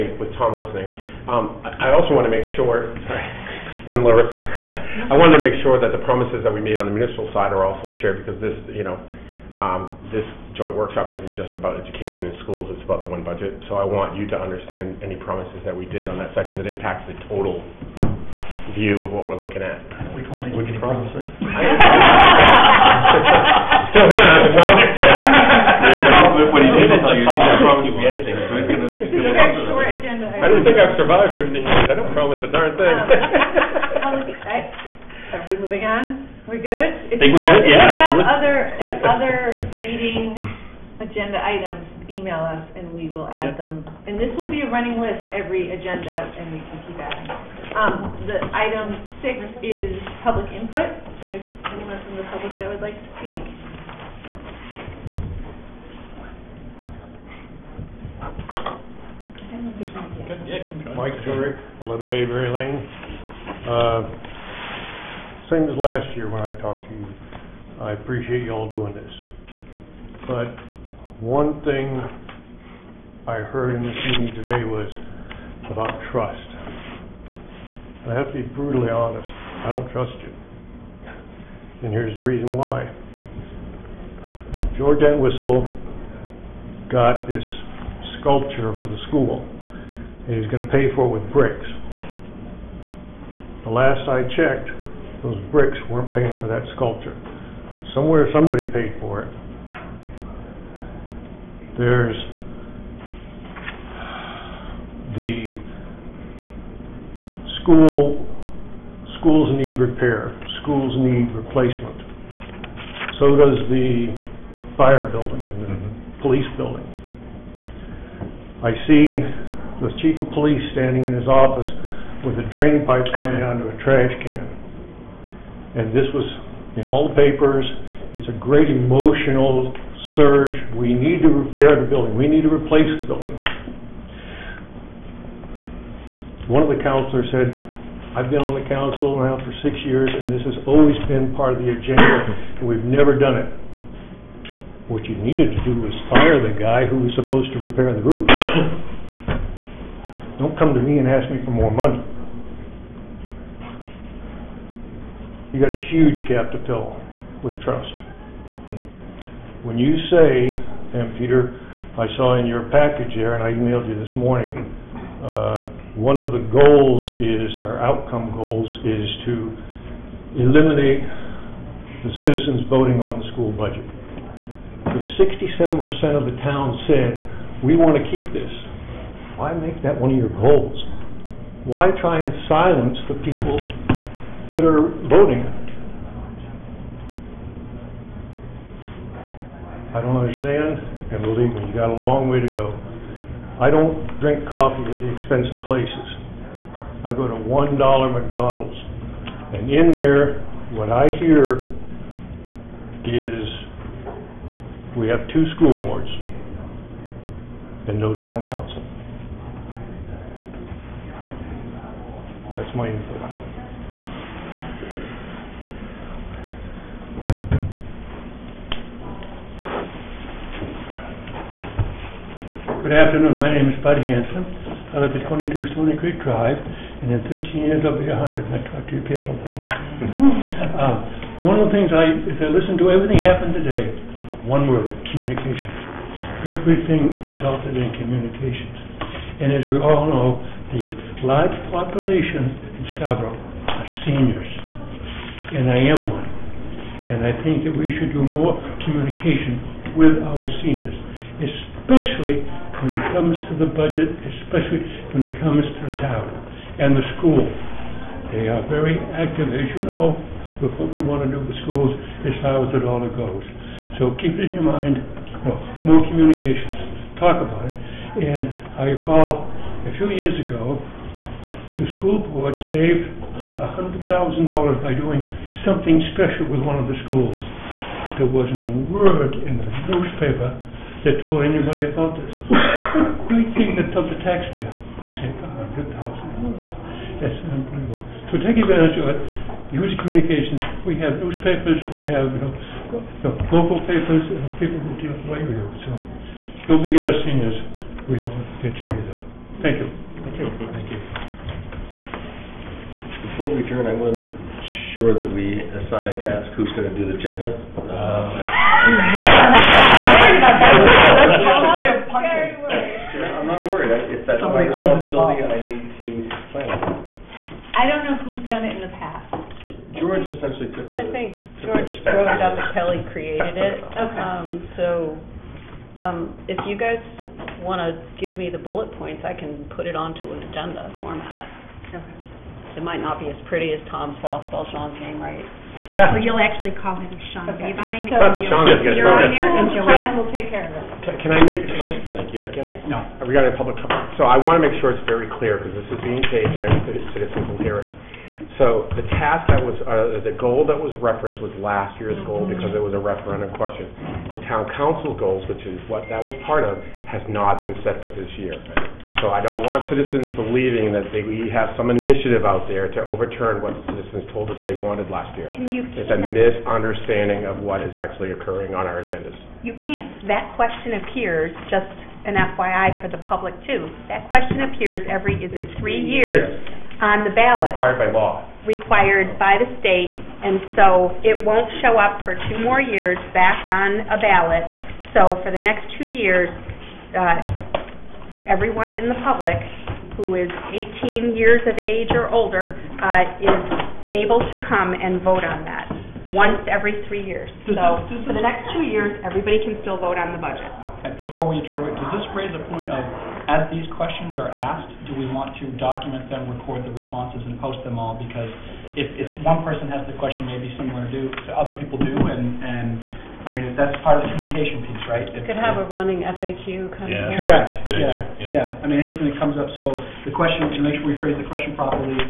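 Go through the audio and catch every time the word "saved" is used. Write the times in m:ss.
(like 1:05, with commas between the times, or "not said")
4:32, 4:45.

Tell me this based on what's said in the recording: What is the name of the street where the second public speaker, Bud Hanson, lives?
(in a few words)
Stony Creek Drive.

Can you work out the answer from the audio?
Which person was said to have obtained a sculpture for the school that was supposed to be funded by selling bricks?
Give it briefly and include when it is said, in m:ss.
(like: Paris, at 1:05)
George Entwistle, at 1:24.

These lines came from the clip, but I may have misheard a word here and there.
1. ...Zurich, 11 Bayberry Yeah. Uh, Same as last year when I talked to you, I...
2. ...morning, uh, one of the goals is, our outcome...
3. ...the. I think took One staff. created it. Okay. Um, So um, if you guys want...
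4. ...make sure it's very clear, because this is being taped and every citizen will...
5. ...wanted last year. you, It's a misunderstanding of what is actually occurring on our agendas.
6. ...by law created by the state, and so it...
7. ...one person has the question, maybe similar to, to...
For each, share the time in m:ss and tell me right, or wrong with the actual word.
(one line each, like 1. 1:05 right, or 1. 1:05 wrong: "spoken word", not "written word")
1. 1:01 wrong: "Lane", not "Yeah"
2. 2:44 right
3. 5:20 wrong: "George", not "One"
4. 5:44 right
5. 6:04 right
6. 6:18 wrong: "required", not "created"
7. 6:49 right.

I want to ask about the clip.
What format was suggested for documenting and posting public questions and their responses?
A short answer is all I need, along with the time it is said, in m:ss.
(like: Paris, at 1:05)
running FAQ, at 6:55.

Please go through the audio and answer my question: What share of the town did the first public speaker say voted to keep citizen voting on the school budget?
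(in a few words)
67%.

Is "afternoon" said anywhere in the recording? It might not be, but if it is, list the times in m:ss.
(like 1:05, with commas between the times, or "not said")
3:42.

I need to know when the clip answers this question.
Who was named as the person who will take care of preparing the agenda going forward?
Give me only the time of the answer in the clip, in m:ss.
5:39.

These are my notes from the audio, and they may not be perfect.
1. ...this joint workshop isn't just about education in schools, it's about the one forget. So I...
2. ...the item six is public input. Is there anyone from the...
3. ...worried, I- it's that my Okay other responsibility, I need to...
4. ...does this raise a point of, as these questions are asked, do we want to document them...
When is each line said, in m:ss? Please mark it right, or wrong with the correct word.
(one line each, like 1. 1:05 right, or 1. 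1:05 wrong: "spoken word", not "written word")
1. 0:10 wrong: "budget", not "forget"
2. 0:48 right
3. 5:13 wrong: "Somebody", not "Okay"
4. 6:41 right.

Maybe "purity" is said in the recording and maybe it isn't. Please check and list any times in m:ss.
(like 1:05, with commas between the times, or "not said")
not said.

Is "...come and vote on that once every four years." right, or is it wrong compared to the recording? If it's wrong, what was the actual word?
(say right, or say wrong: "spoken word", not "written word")
wrong: "three", not "four".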